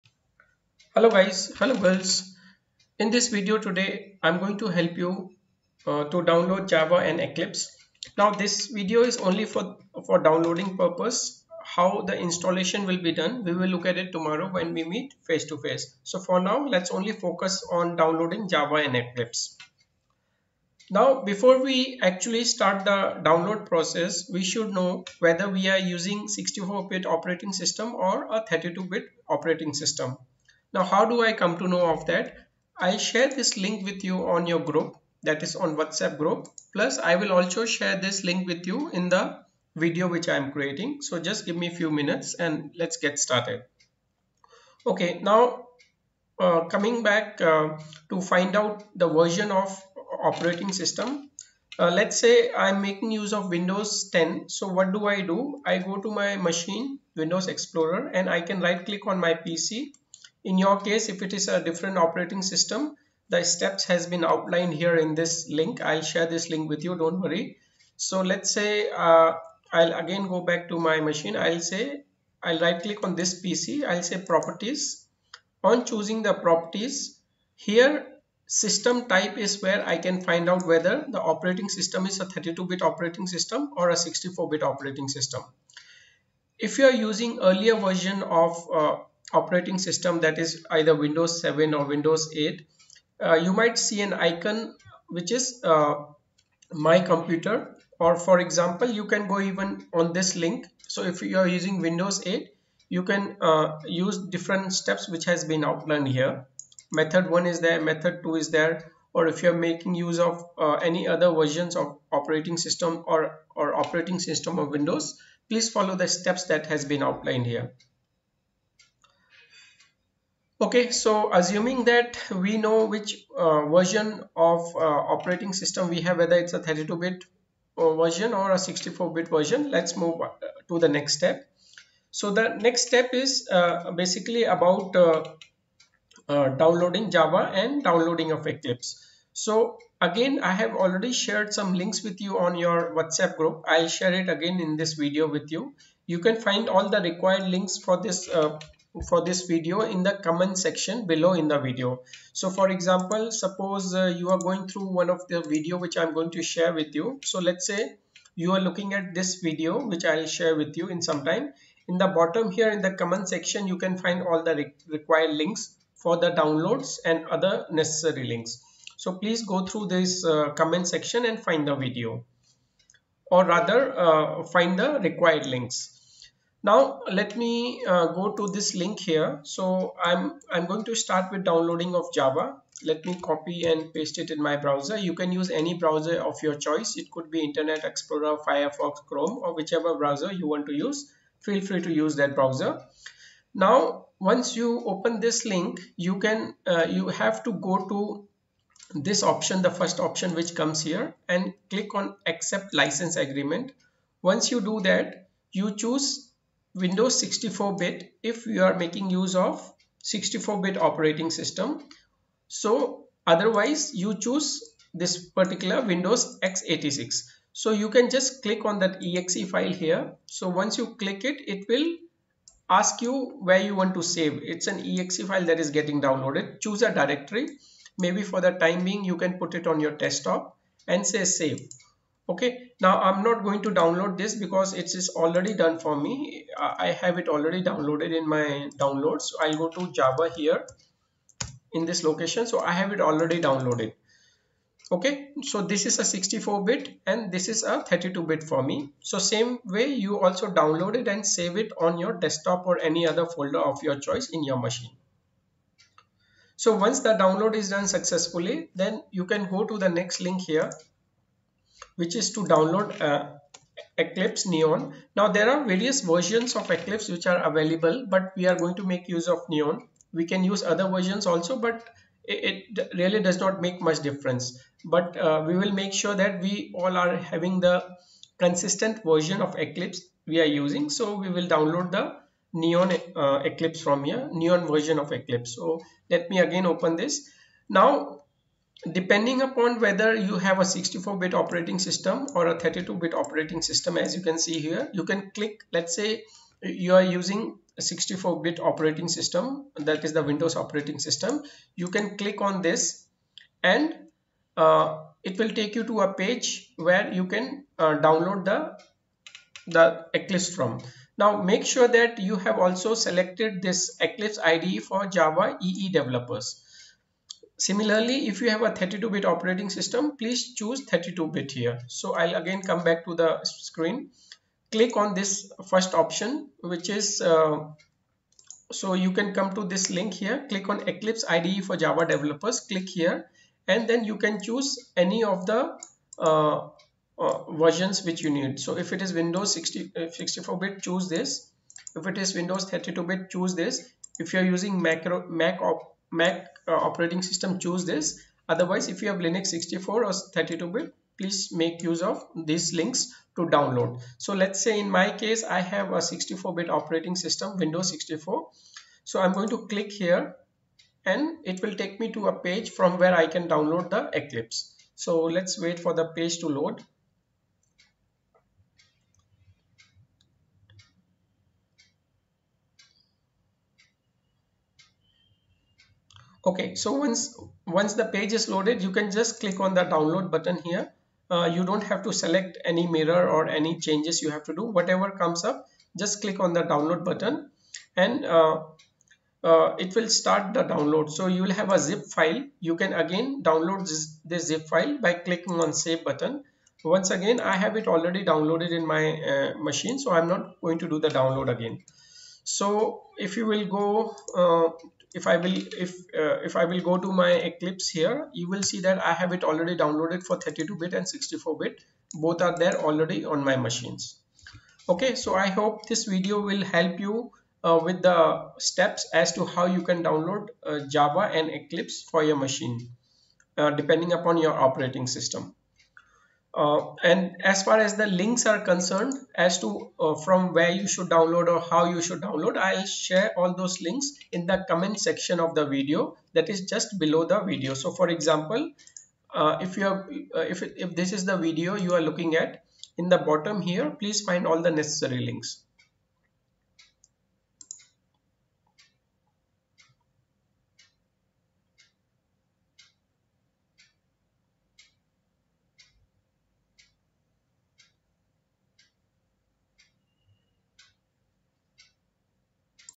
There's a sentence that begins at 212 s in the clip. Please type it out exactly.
So otherwise you choose this particular Windows x86.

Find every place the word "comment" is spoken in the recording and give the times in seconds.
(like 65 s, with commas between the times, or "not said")
150 s, 162 s, 170 s, 434 s.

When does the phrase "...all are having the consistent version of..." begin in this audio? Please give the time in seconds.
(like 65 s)
276 s.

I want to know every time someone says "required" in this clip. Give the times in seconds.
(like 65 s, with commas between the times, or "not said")
147 s, 164 s, 174 s.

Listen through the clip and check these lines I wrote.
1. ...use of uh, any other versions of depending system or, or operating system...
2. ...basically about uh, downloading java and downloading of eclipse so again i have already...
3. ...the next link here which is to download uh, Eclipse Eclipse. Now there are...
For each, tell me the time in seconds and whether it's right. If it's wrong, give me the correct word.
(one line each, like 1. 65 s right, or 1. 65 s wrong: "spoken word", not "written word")
1. 109 s wrong: "operating", not "depending"
2. 134 s right
3. 259 s wrong: "Neon", not "Eclipse".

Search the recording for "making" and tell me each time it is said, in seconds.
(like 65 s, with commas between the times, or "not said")
52 s, 109 s, 208 s.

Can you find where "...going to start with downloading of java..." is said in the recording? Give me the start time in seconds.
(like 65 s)
180 s.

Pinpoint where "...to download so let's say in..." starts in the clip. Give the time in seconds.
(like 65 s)
353 s.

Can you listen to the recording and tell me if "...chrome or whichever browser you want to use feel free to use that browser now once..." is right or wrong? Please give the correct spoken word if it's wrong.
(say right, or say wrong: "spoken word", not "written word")
right.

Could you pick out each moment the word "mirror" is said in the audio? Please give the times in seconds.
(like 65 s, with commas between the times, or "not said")
382 s.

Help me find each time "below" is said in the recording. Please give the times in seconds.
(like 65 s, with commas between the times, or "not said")
151 s, 436 s.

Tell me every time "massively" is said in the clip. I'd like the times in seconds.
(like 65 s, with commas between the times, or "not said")
not said.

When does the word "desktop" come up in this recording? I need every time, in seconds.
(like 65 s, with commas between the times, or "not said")
229 s, 252 s.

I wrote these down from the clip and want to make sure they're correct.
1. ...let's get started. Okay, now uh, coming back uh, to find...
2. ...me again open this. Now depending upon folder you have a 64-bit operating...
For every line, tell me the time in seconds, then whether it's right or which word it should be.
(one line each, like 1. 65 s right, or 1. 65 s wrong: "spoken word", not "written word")
1. 42 s right
2. 286 s wrong: "whether", not "folder".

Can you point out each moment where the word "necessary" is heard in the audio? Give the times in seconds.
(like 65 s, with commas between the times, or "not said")
167 s, 444 s.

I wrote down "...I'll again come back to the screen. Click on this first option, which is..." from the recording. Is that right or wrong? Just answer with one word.
right.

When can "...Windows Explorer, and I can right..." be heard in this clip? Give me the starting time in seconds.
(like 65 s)
57 s.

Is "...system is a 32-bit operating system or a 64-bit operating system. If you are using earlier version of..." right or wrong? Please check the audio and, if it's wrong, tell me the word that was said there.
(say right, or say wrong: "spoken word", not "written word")
right.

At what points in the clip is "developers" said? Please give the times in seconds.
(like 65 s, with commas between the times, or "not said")
315 s, 332 s.